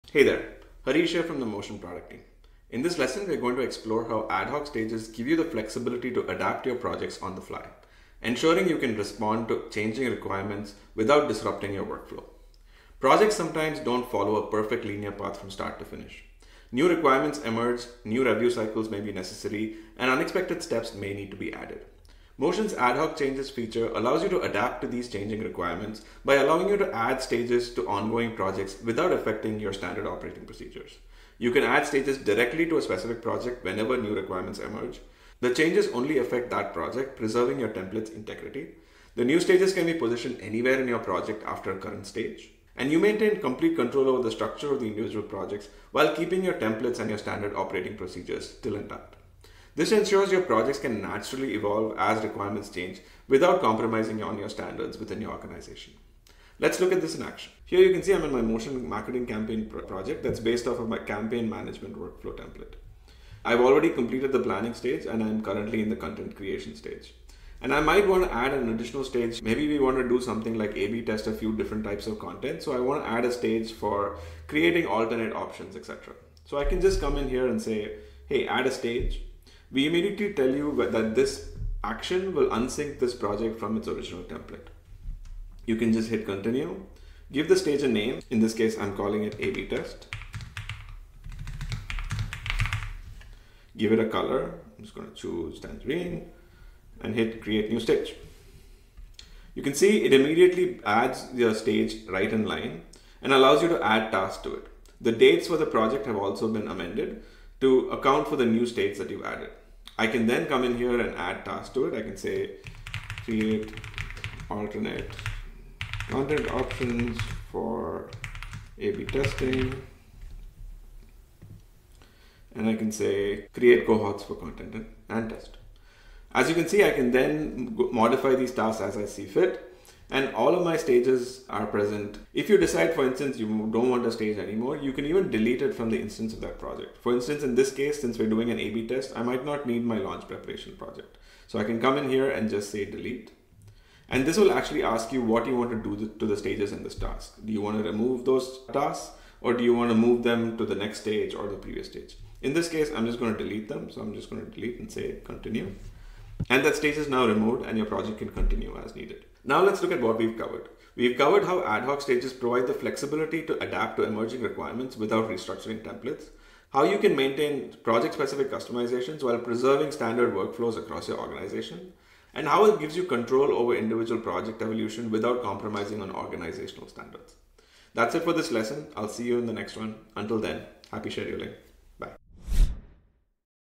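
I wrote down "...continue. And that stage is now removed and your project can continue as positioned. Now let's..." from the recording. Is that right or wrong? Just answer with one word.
wrong.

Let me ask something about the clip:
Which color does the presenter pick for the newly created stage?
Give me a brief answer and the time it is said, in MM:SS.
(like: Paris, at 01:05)
tangerine, at 01:35.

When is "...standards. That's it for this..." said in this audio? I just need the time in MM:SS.
02:56.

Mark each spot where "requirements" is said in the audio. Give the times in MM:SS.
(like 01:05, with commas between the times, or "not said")
00:10, 00:16, 00:25, 00:34, 00:52, 02:44.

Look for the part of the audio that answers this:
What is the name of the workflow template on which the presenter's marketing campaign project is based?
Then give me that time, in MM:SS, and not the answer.
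01:00.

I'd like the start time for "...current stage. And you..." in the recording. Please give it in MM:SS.
00:41.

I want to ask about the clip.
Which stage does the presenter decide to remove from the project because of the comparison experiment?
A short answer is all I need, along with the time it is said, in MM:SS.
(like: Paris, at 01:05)
launch preparation, at 02:19.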